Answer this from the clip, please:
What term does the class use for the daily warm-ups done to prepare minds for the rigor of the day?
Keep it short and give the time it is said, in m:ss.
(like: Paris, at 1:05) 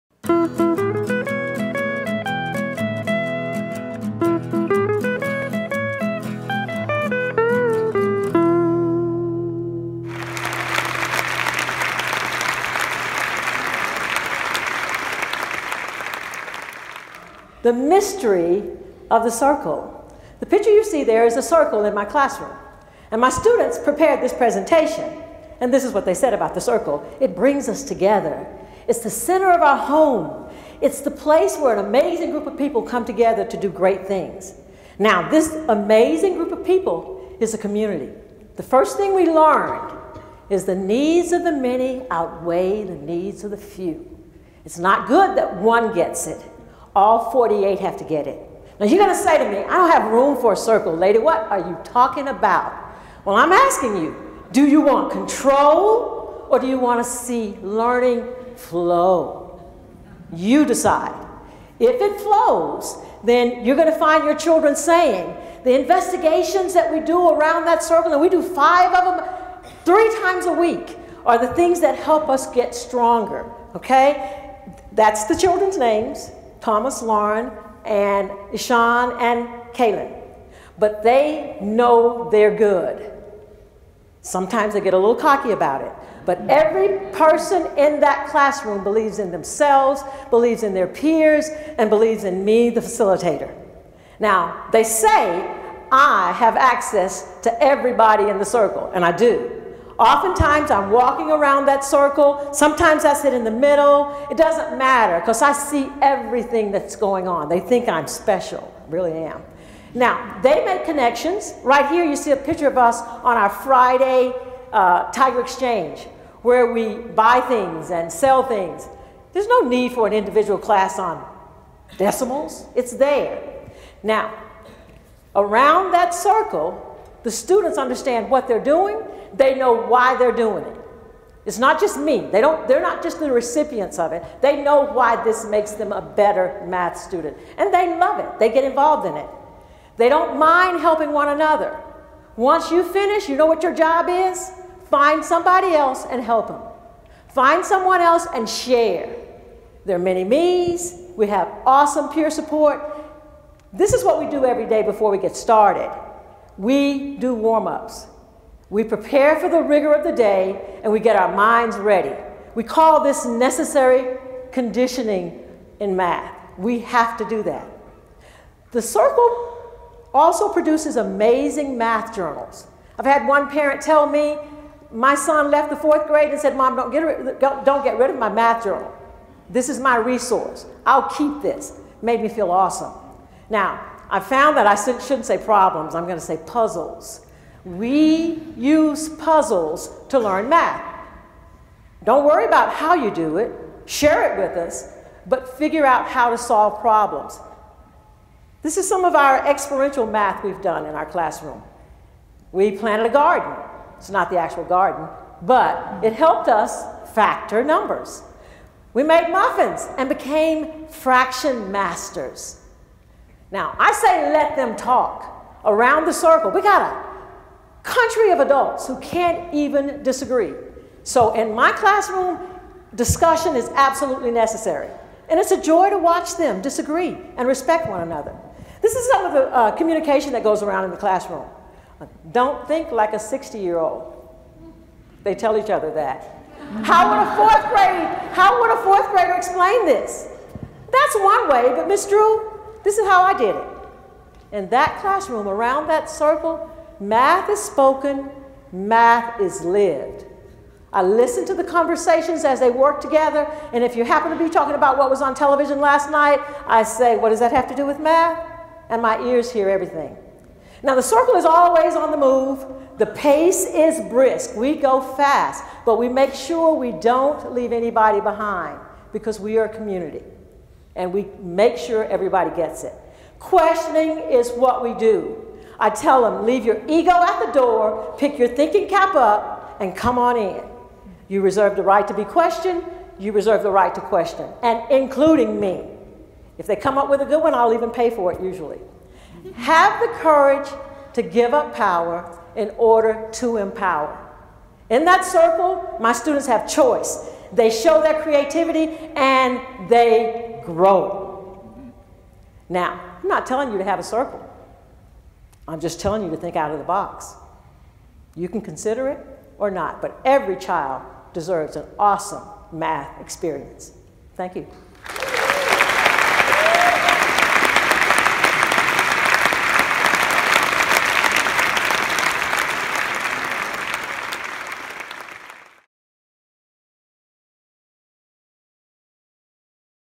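necessary conditioning, at 2:43.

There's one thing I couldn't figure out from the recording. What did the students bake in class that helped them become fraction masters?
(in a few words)
muffins.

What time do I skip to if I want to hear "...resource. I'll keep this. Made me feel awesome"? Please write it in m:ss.
2:59.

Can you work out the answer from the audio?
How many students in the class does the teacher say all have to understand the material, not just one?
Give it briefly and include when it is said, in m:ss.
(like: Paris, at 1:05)
48, at 0:47.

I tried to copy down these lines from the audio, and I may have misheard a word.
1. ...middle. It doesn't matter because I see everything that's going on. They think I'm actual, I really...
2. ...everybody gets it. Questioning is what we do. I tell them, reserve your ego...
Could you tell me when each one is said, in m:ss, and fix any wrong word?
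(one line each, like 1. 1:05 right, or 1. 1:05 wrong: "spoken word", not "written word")
1. 1:43 wrong: "special", not "actual"
2. 4:32 wrong: "leave", not "reserve".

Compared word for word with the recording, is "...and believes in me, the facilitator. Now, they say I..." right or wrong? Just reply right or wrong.
right.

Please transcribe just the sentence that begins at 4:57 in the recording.
They show their creativity and they grow.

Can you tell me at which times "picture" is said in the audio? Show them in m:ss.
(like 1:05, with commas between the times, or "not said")
0:20, 1:52.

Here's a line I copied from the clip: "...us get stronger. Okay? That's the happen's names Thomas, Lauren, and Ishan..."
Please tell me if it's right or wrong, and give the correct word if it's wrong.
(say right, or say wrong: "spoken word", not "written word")
wrong: "children", not "happen".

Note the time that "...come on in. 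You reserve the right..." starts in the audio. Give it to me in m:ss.
4:39.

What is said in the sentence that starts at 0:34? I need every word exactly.
Now, this amazing group of people is a community.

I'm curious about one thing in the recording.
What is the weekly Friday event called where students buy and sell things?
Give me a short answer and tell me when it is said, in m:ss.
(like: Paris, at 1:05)
Tiger Exchange, at 1:55.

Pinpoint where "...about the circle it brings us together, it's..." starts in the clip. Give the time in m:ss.
0:26.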